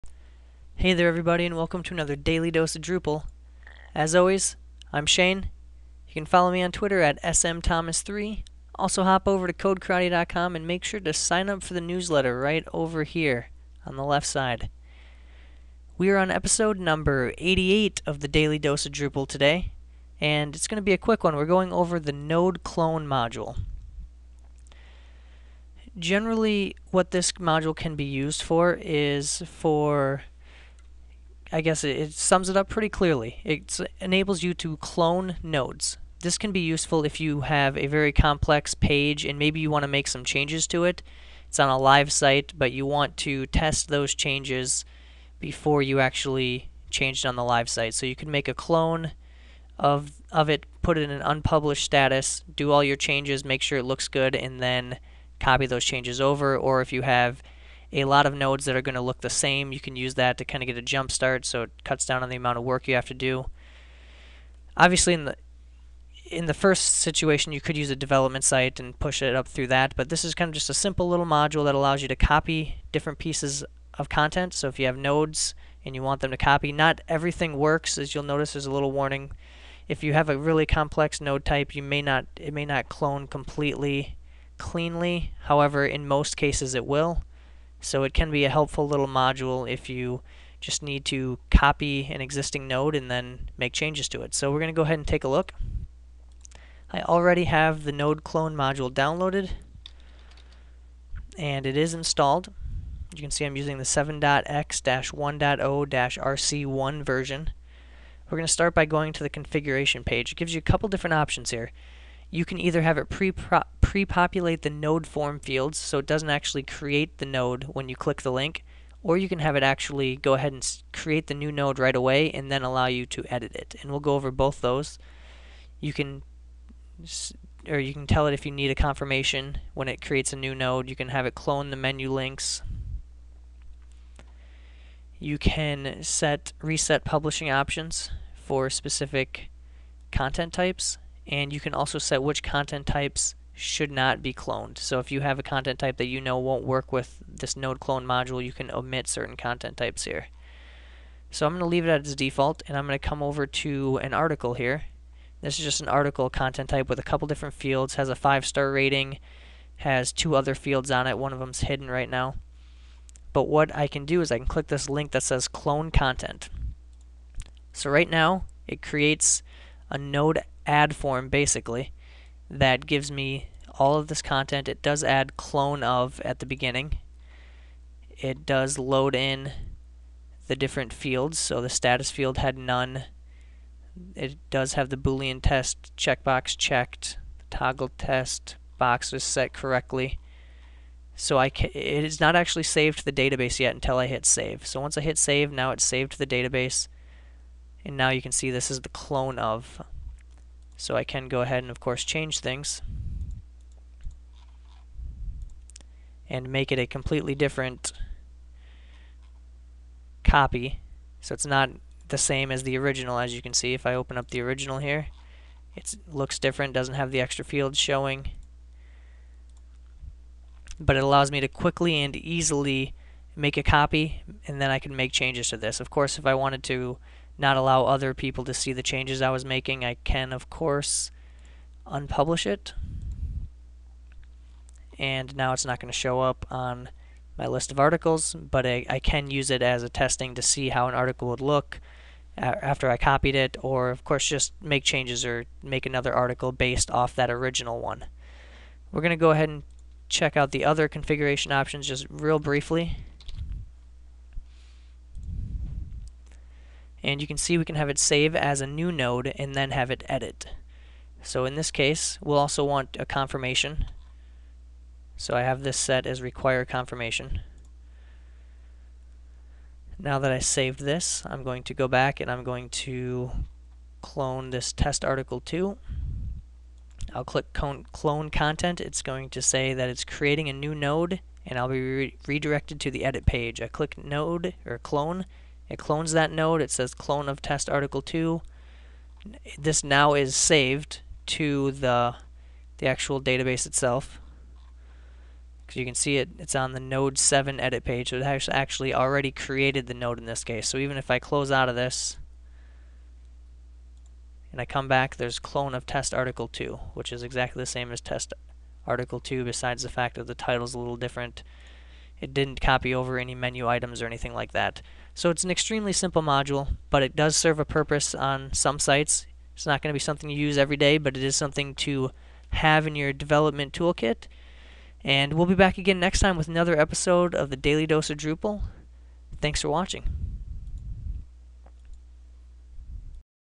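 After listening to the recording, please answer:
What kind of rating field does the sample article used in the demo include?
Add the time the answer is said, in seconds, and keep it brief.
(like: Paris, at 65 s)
5-star rating, at 158 s.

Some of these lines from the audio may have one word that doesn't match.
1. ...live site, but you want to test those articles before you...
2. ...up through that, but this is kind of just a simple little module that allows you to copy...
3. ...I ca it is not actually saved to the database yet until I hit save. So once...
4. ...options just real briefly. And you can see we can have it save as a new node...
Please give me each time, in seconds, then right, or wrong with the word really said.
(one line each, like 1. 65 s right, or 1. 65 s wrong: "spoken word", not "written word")
1. 41 s wrong: "changes", not "articles"
2. 69 s right
3. 191 s right
4. 251 s right.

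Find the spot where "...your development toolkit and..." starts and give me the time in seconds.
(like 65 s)
322 s.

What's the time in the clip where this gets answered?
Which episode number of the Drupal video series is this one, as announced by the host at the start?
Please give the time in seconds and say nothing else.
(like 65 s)
16 s.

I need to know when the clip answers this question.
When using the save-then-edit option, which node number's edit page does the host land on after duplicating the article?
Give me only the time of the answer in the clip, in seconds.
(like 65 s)
296 s.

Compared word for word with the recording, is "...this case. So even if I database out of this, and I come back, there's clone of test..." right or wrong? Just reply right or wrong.
wrong.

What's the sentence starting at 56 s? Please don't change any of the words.
Or if you have a lot of nodes that are going to look the same.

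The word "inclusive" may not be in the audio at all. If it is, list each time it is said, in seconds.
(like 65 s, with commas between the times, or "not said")
not said.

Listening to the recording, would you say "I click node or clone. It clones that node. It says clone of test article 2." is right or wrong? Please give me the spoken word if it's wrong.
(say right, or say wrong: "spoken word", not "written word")
right.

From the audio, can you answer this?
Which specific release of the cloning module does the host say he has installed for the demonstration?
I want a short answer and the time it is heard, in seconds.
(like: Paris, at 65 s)
7.x-1.0-rc1, at 103 s.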